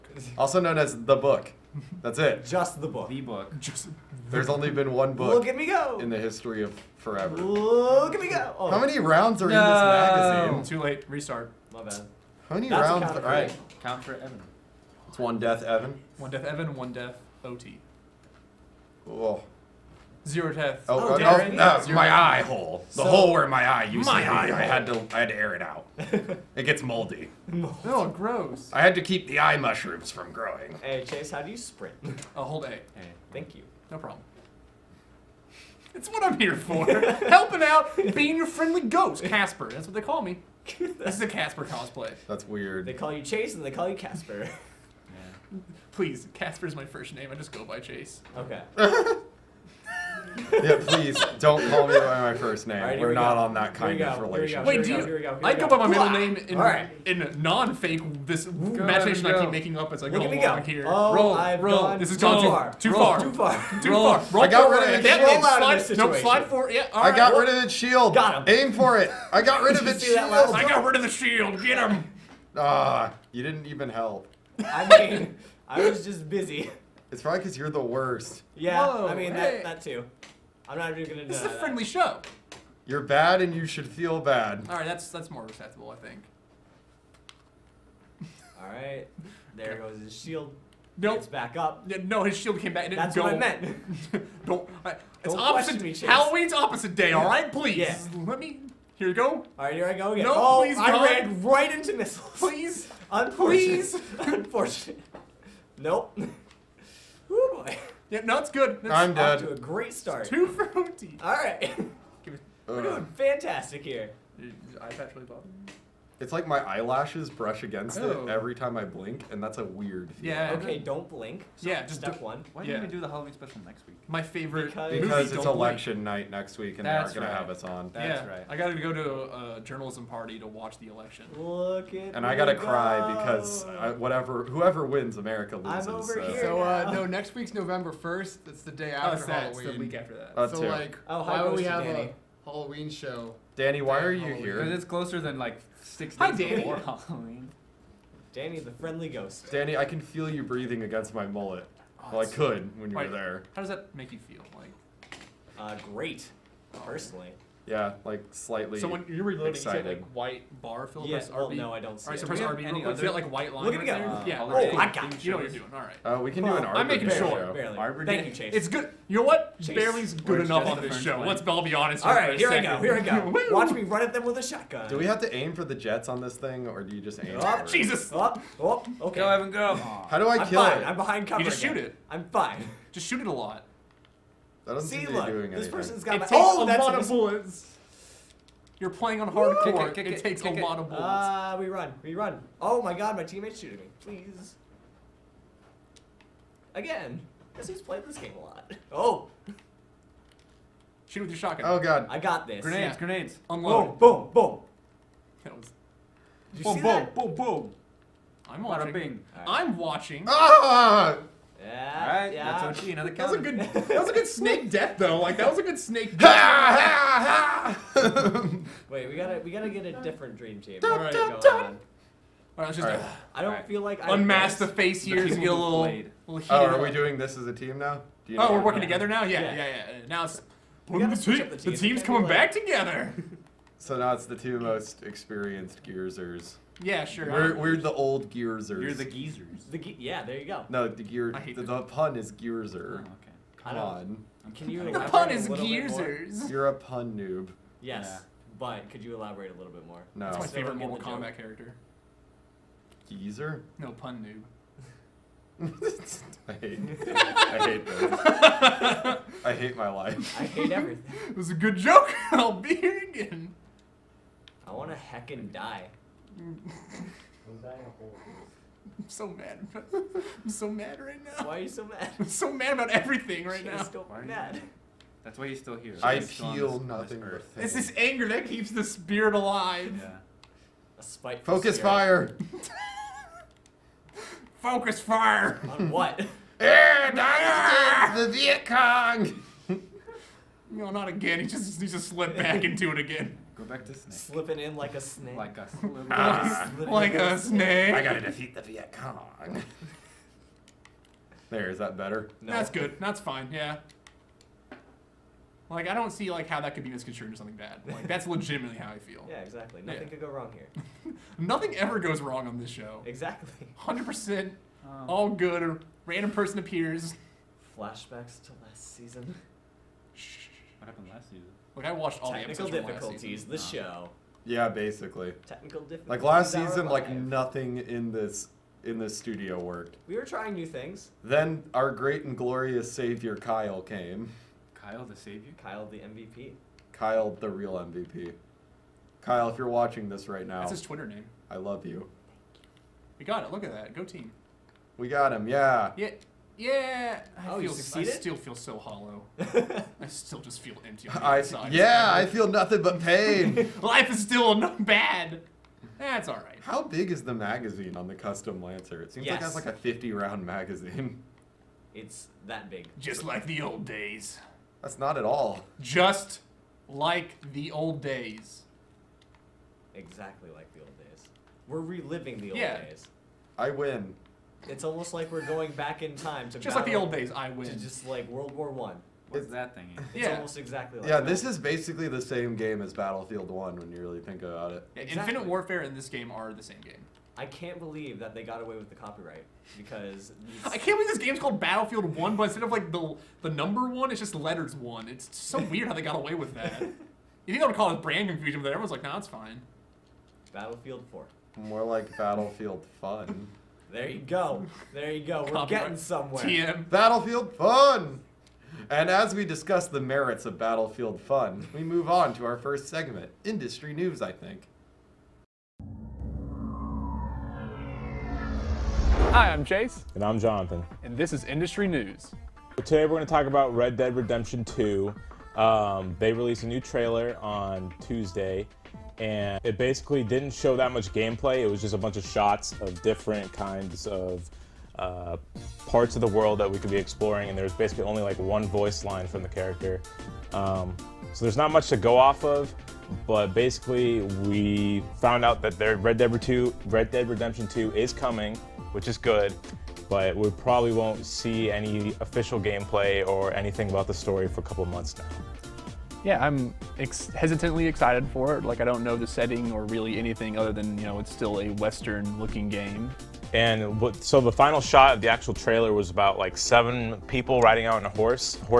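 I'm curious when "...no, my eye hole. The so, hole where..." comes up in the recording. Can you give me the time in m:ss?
0:21.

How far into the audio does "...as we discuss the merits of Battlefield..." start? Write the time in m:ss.
6:49.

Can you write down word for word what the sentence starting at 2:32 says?
Oh, well, I could when you wait, were there.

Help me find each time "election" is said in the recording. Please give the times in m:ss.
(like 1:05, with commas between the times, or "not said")
2:05, 2:10.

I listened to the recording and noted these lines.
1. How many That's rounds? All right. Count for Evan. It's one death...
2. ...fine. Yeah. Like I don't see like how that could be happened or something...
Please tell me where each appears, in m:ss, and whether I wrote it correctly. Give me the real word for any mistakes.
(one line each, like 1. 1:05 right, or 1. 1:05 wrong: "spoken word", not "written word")
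1. 0:12 right
2. 5:03 wrong: "misconstrued", not "happened".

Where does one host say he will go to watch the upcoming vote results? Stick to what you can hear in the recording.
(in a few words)
A journalism party.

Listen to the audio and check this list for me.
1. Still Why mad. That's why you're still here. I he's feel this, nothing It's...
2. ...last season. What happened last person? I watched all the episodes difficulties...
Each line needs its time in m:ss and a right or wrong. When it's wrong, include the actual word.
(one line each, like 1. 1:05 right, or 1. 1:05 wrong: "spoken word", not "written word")
1. 4:33 right
2. 5:18 wrong: "season", not "person".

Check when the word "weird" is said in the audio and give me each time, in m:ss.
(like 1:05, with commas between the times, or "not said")
0:42, 1:59, 6:35.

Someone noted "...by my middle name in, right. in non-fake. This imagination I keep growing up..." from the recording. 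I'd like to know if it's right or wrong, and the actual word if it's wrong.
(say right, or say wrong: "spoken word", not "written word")
wrong: "making", not "growing".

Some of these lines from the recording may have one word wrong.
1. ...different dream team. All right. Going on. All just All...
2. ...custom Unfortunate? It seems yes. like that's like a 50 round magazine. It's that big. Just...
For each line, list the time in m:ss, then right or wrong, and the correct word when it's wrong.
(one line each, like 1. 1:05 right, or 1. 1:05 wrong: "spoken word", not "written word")
1. 3:40 right
2. 5:58 wrong: "Lancer", not "Unfortunate".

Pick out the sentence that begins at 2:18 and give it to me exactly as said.
That's the day oh, after oh, so Halloween.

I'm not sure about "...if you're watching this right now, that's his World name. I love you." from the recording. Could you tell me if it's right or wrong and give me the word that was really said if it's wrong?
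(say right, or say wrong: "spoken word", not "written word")
wrong: "Twitter", not "World".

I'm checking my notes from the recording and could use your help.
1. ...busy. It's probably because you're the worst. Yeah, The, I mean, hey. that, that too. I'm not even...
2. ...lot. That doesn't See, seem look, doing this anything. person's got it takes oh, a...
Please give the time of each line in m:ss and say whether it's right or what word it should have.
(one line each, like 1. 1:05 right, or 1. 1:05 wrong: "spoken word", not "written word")
1. 1:16 wrong: "Whoa", not "The"
2. 3:03 right.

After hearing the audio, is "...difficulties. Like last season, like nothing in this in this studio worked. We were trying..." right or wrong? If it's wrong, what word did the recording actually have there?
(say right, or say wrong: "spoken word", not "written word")
right.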